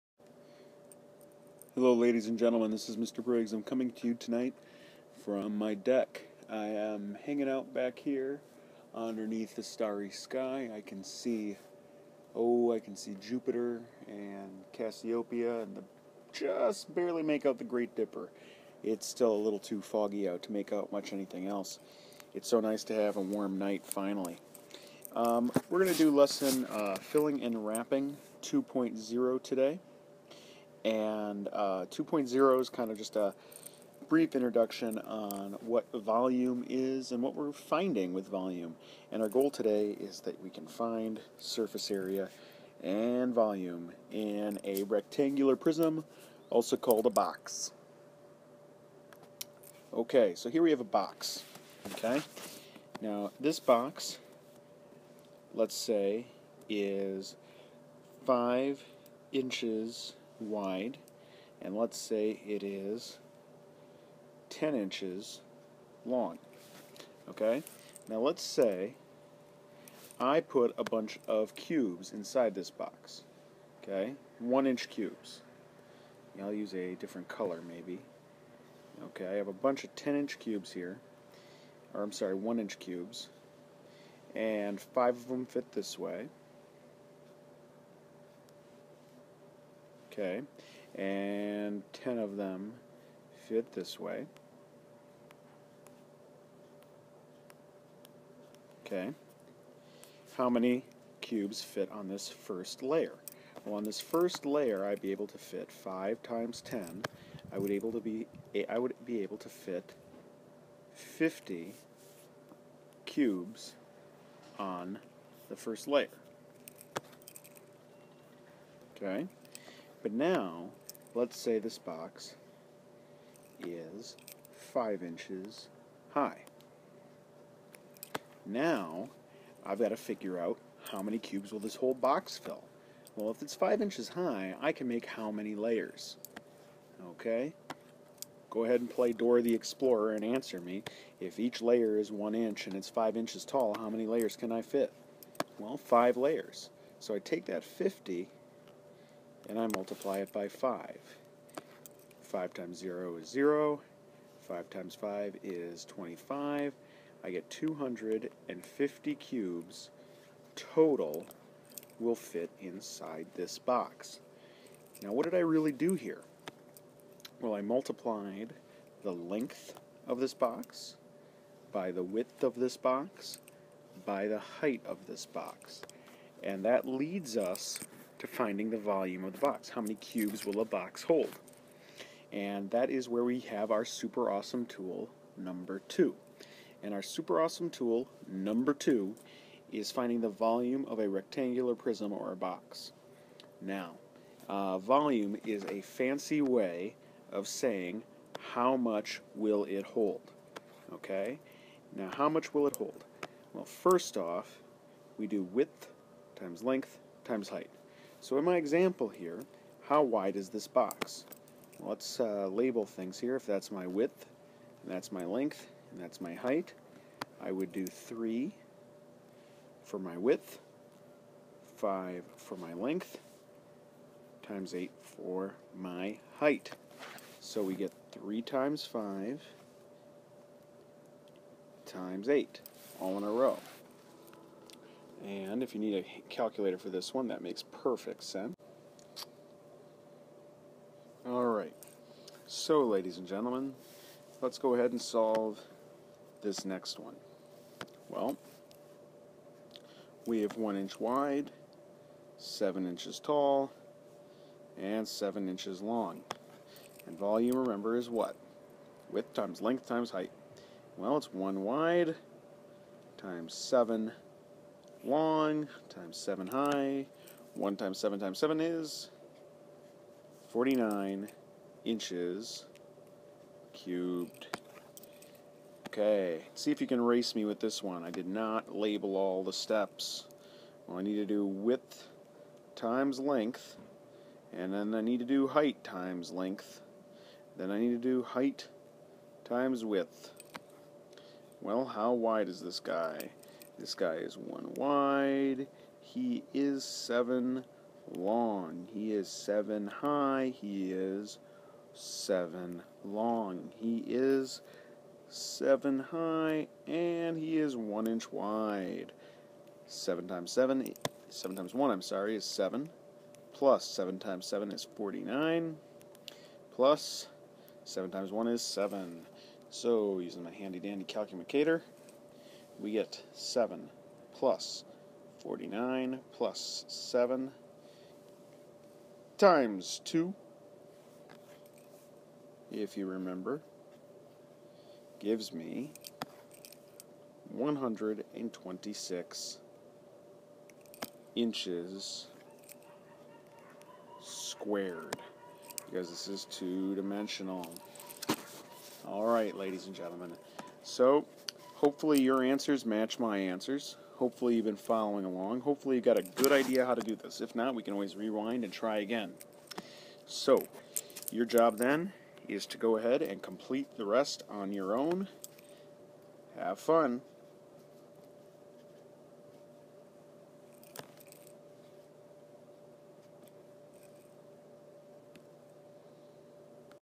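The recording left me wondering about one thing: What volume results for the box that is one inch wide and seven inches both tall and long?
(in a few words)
49 inches cubed.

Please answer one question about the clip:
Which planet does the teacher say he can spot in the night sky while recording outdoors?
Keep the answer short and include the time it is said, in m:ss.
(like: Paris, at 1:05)
Jupiter, at 0:13.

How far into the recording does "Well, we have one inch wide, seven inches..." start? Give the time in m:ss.
4:08.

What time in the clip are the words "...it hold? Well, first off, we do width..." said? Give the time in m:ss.
3:22.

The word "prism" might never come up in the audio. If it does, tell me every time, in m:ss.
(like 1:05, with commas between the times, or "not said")
0:45, 3:11.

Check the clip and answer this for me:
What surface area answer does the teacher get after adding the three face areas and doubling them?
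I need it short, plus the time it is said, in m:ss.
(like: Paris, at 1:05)
126 inches squared, at 5:37.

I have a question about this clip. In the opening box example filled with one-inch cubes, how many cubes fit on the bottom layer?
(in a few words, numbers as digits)
50.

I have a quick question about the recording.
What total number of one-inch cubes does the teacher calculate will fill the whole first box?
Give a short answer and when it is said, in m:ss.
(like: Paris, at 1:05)
250, at 2:37.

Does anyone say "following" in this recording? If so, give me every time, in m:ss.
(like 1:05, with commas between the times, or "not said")
5:54.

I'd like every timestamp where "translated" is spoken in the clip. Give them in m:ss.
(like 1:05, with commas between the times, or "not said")
not said.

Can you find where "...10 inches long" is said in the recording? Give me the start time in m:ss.
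1:04.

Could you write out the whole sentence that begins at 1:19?
Okay, I have a bunch of 10 inch cubes here.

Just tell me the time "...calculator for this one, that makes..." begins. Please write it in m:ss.
3:56.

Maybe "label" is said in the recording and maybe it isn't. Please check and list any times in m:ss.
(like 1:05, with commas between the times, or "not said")
3:32, 4:38.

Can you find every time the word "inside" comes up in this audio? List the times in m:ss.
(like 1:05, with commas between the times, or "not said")
1:12, 2:42.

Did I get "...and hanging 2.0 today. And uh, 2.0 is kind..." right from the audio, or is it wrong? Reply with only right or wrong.
wrong.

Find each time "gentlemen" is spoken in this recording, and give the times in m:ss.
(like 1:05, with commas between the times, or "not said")
0:02, 4:03, 5:49.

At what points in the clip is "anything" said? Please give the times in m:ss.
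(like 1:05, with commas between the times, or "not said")
0:21.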